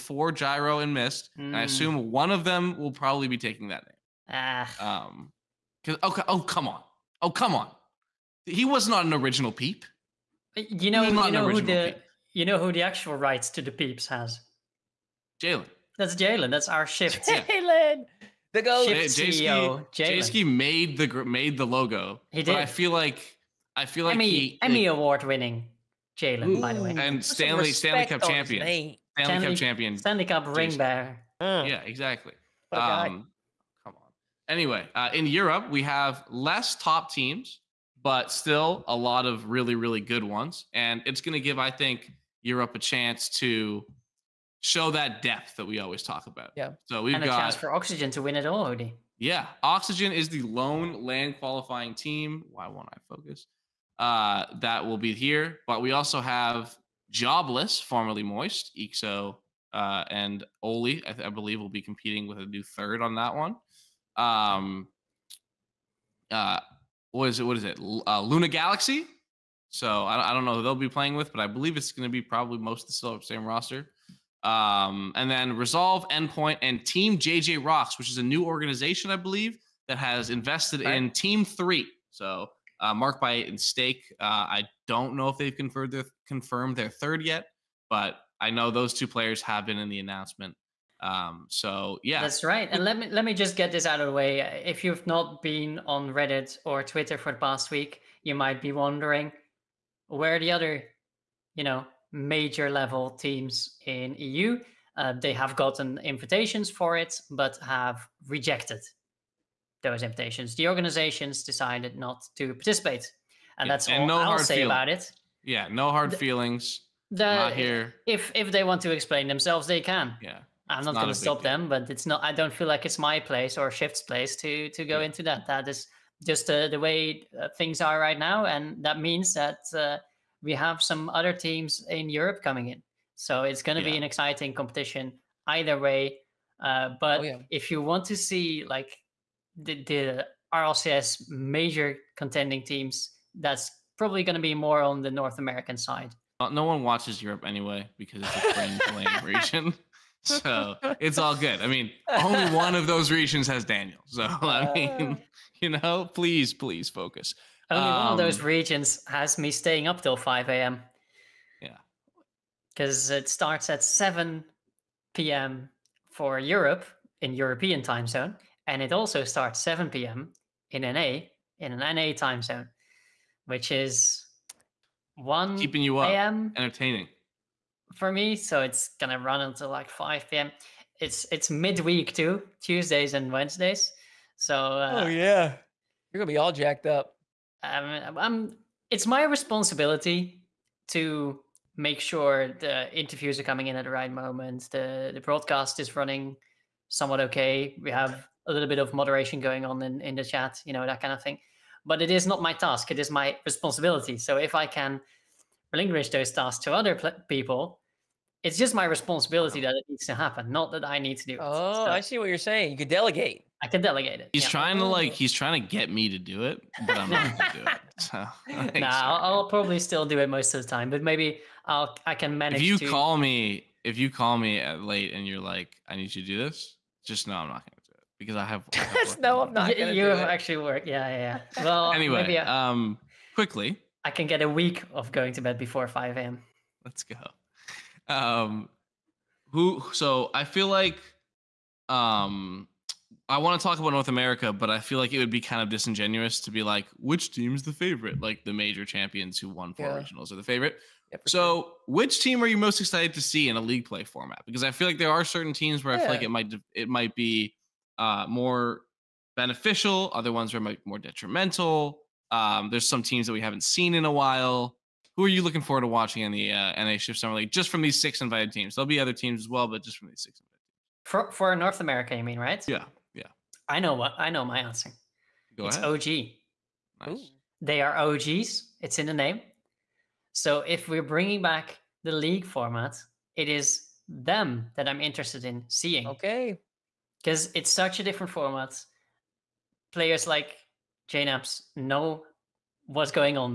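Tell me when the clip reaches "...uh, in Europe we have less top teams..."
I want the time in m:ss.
0:34.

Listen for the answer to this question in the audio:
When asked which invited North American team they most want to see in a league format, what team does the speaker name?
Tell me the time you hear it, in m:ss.
4:35.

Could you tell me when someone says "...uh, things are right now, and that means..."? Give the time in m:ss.
2:07.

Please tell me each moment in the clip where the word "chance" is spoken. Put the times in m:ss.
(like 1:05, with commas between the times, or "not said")
0:42, 0:47.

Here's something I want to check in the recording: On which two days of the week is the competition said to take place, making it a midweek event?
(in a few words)
Tuesdays and Wednesdays.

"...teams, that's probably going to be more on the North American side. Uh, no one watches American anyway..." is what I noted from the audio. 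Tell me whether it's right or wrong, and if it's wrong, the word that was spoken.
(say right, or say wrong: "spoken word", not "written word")
wrong: "Europe", not "American".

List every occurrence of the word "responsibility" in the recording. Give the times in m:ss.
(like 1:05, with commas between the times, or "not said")
3:09, 3:23, 3:28.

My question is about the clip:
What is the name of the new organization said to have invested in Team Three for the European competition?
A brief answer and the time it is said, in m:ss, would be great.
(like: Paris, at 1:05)
Team JJ Rocks, at 1:16.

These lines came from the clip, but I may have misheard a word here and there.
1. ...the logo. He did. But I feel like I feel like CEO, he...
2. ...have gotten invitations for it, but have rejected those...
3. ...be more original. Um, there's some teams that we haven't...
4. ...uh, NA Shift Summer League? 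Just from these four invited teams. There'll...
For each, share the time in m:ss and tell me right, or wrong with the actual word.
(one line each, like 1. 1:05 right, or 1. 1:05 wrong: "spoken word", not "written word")
1. 0:21 wrong: "Emmy", not "CEO"
2. 1:45 right
3. 4:20 wrong: "detrimental", not "original"
4. 4:26 wrong: "six", not "four".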